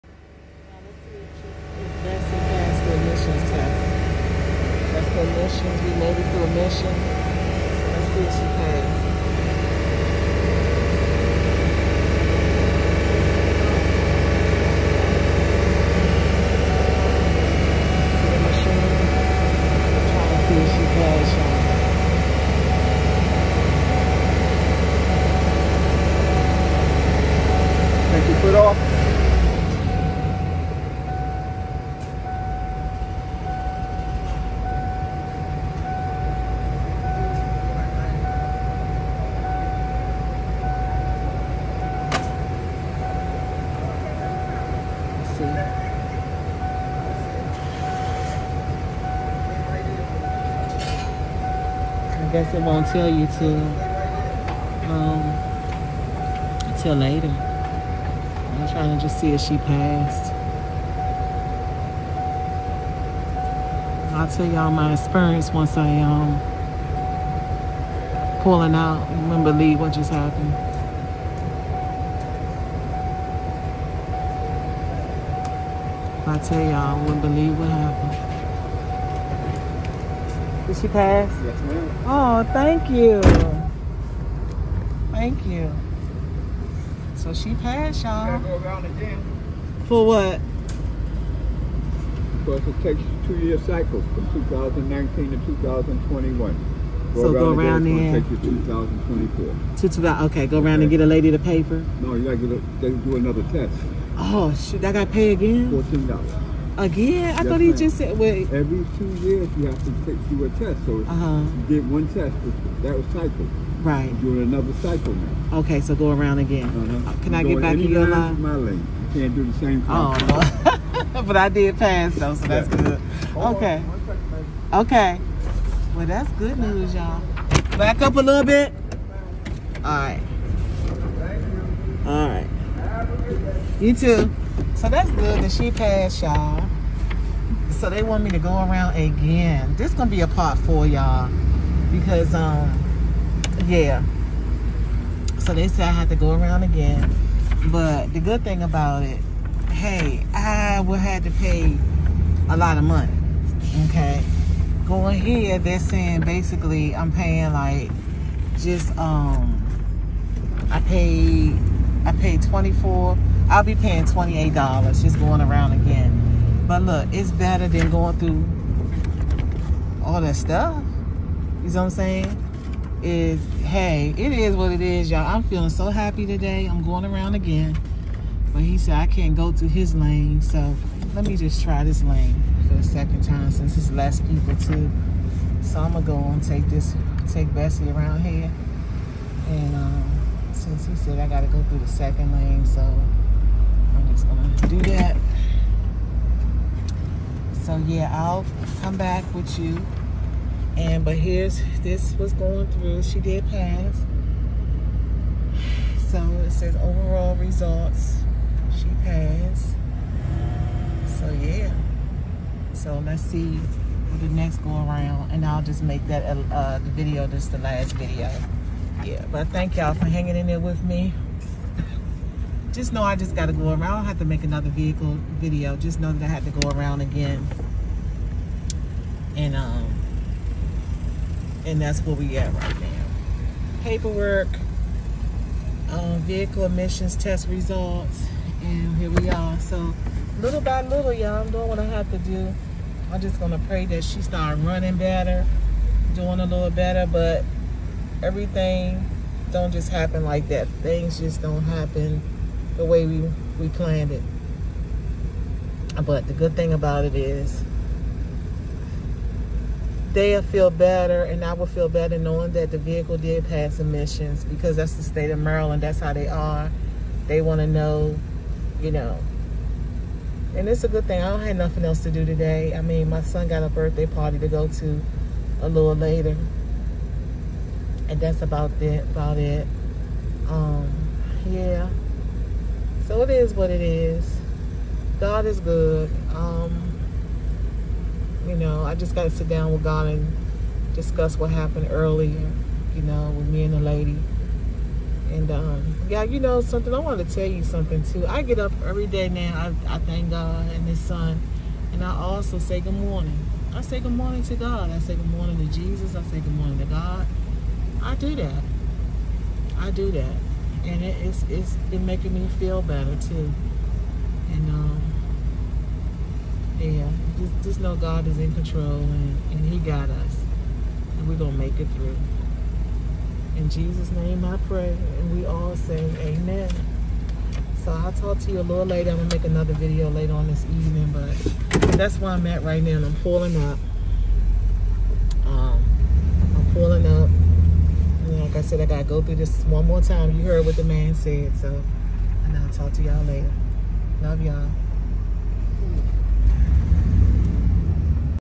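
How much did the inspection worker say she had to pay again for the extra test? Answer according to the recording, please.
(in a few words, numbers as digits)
$14.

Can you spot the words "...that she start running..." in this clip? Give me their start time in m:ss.
4:03.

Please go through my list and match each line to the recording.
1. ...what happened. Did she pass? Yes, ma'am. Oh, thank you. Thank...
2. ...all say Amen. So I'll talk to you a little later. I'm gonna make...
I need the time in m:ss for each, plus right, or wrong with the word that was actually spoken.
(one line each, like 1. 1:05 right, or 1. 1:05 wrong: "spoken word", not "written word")
1. 1:17 right
2. 5:25 right.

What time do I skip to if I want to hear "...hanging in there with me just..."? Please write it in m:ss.
3:40.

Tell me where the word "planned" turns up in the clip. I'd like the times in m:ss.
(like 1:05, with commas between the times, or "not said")
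4:13.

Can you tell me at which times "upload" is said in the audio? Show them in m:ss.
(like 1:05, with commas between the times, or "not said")
not said.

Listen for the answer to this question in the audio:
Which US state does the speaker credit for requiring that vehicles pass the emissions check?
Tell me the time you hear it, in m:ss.
4:25.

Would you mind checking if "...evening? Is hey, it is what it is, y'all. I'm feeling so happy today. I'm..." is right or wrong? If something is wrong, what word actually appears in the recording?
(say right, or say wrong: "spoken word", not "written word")
wrong: "saying", not "evening".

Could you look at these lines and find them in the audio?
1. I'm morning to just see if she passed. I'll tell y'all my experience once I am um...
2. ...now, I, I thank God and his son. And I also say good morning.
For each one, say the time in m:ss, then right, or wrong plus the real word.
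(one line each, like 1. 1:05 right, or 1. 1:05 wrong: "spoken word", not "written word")
1. 0:57 wrong: "trying", not "morning"
2. 4:59 right.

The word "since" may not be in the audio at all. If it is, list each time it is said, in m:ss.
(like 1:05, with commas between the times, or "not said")
3:03, 3:10.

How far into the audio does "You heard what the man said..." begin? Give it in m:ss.
5:40.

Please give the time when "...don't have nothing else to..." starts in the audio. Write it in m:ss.
4:31.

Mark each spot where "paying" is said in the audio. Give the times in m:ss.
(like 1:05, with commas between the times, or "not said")
2:37, 2:43.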